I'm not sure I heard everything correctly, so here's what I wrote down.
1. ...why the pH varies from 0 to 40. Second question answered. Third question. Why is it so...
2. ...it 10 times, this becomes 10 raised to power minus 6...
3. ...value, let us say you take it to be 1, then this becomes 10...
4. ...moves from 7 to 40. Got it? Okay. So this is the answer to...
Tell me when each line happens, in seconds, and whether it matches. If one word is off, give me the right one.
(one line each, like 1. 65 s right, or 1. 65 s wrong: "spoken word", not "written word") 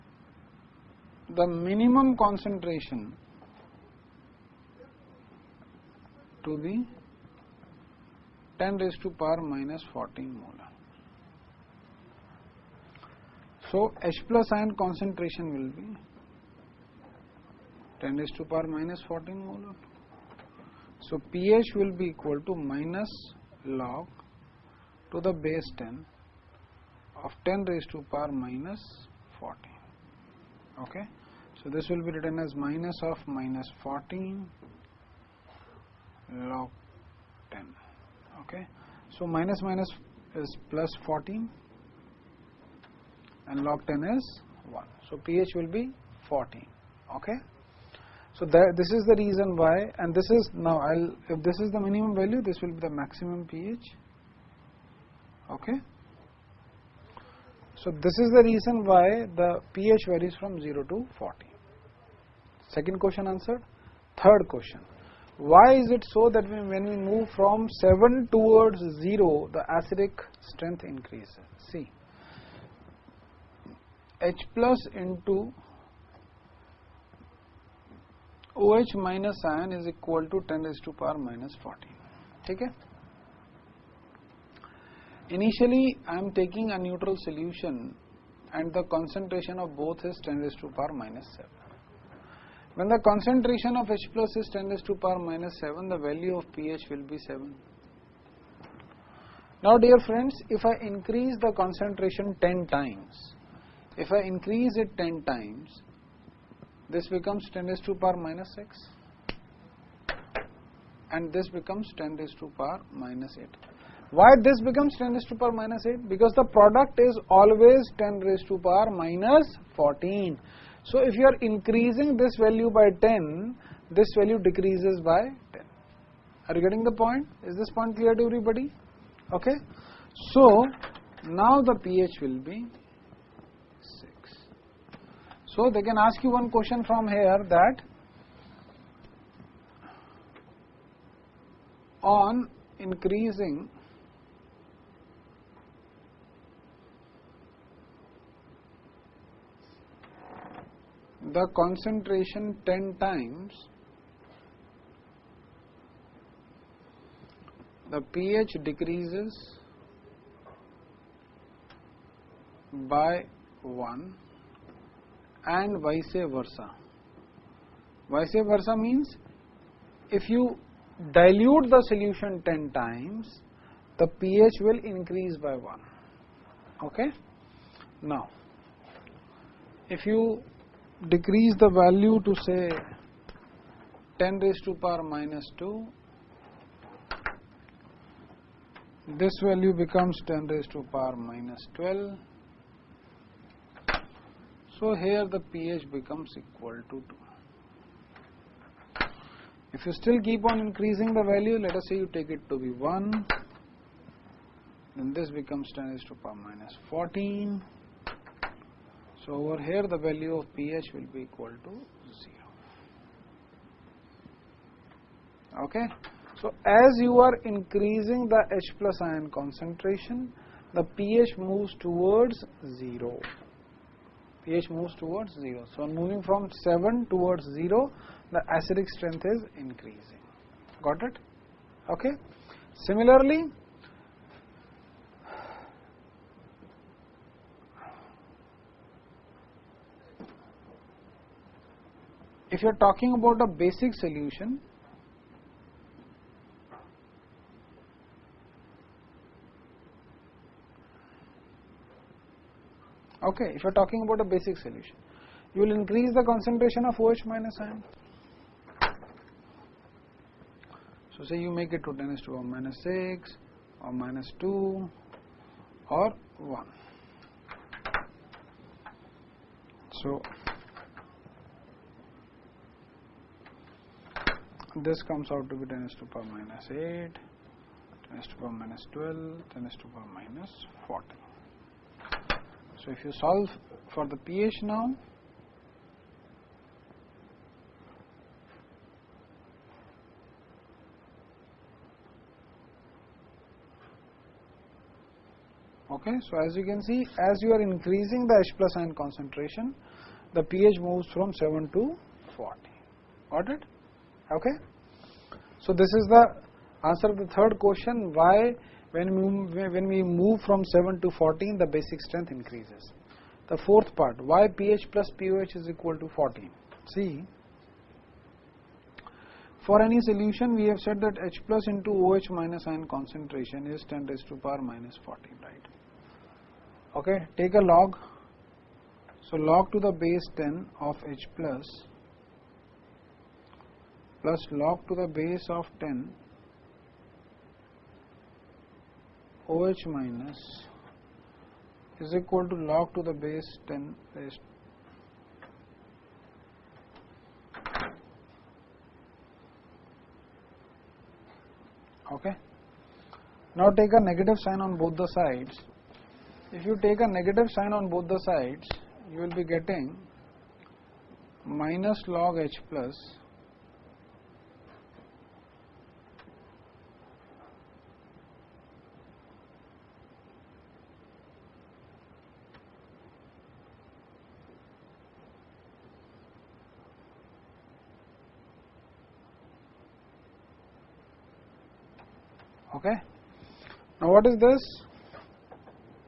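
1. 58 s right
2. 104 s right
3. 201 s right
4. 300 s right.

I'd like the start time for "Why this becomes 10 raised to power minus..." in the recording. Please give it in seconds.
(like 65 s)
114 s.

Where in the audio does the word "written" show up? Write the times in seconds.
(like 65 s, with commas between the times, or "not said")
32 s.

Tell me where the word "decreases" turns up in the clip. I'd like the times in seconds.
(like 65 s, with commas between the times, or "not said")
124 s, 158 s, 181 s.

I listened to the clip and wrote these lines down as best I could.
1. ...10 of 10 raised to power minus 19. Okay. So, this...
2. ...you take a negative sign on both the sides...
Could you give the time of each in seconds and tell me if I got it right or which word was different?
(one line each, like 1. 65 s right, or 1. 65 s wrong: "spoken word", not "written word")
1. 25 s wrong: "14", not "19"
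2. 356 s right.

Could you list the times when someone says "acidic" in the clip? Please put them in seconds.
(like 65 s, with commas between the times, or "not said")
69 s, 228 s.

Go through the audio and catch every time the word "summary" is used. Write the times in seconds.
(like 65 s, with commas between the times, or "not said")
not said.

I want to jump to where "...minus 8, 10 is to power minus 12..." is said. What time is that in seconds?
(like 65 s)
276 s.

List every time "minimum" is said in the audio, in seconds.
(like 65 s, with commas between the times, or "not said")
1 s, 51 s.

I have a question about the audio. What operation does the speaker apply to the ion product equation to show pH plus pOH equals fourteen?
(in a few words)
Take a log.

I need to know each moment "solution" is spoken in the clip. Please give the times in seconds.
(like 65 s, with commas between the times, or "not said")
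87 s, 171 s, 243 s, 254 s, 320 s.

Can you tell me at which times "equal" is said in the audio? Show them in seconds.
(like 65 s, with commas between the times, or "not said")
22 s, 79 s, 196 s, 211 s, 315 s, 342 s.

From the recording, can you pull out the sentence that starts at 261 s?
So say you make it to 10 is to 1 minus 6 or minus 2 or 1.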